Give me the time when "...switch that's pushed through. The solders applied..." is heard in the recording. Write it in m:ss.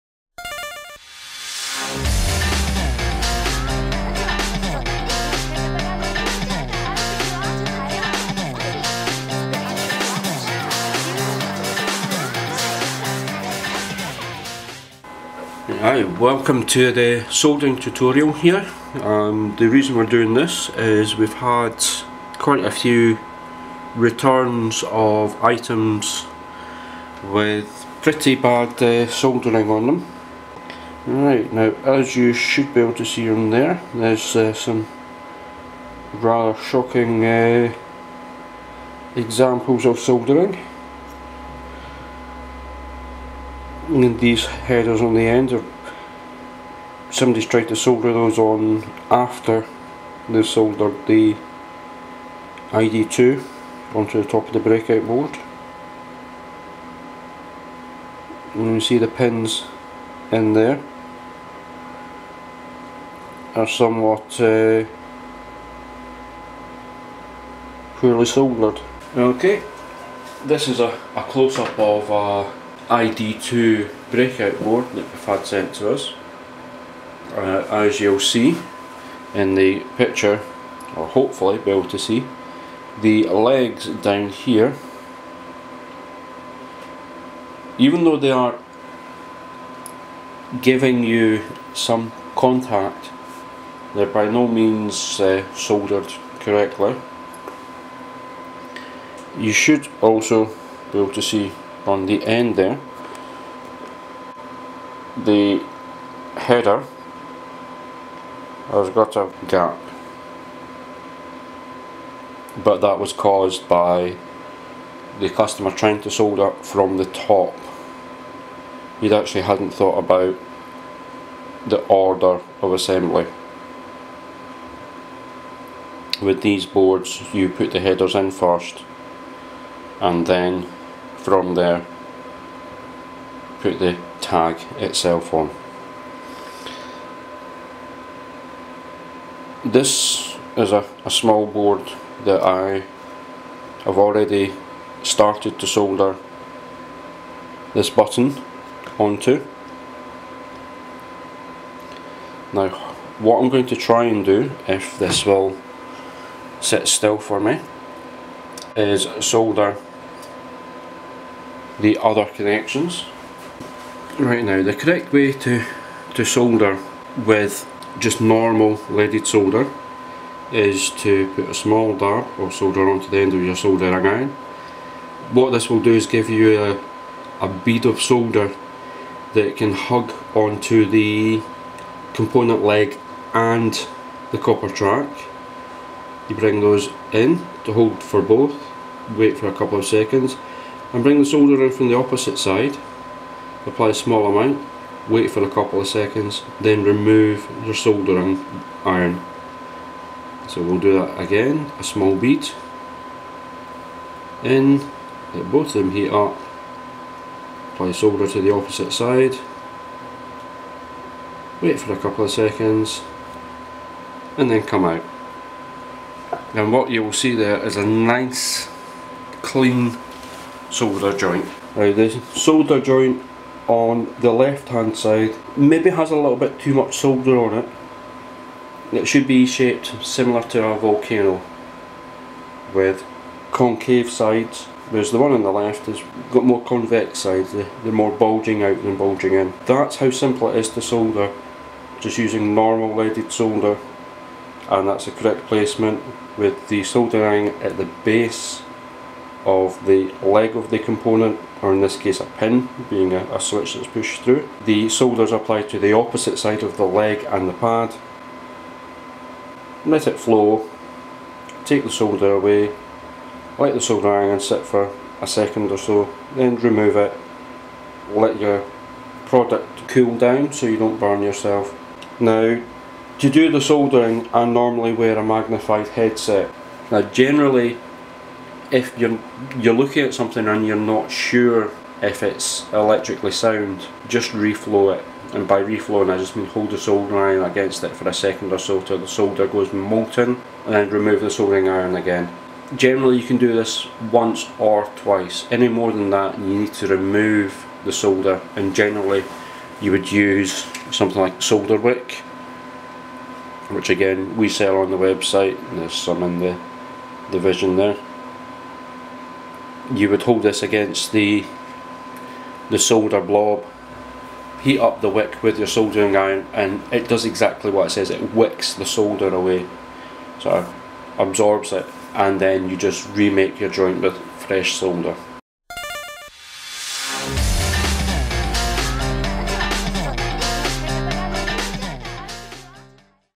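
4:13.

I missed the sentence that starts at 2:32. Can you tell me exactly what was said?
Now what I'm going to try and do, if this will sit still for me, is solder the other connections.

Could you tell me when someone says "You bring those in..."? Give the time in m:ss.
3:06.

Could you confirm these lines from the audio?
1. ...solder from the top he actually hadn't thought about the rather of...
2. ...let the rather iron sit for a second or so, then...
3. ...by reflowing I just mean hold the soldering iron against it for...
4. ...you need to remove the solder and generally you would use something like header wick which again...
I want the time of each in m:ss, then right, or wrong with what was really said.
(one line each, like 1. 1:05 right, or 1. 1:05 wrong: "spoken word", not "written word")
1. 1:56 wrong: "order", not "rather"
2. 4:23 wrong: "solder", not "rather"
3. 4:45 right
4. 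4:56 wrong: "solder", not "header".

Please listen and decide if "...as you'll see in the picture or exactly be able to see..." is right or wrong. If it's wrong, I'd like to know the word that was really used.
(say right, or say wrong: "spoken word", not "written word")
wrong: "hopefully", not "exactly".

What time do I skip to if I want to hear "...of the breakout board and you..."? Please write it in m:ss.
0:54.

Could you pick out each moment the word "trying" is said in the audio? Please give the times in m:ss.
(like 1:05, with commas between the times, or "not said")
1:55.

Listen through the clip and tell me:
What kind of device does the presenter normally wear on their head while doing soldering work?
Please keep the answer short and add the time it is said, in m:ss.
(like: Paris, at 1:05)
Magnified headset, at 4:35.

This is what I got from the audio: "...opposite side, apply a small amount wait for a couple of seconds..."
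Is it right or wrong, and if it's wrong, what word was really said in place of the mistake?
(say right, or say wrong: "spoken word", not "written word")
right.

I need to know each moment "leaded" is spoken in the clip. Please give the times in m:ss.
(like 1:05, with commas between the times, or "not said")
2:48, 4:02.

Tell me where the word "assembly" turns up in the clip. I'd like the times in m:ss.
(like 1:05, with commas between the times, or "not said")
2:02.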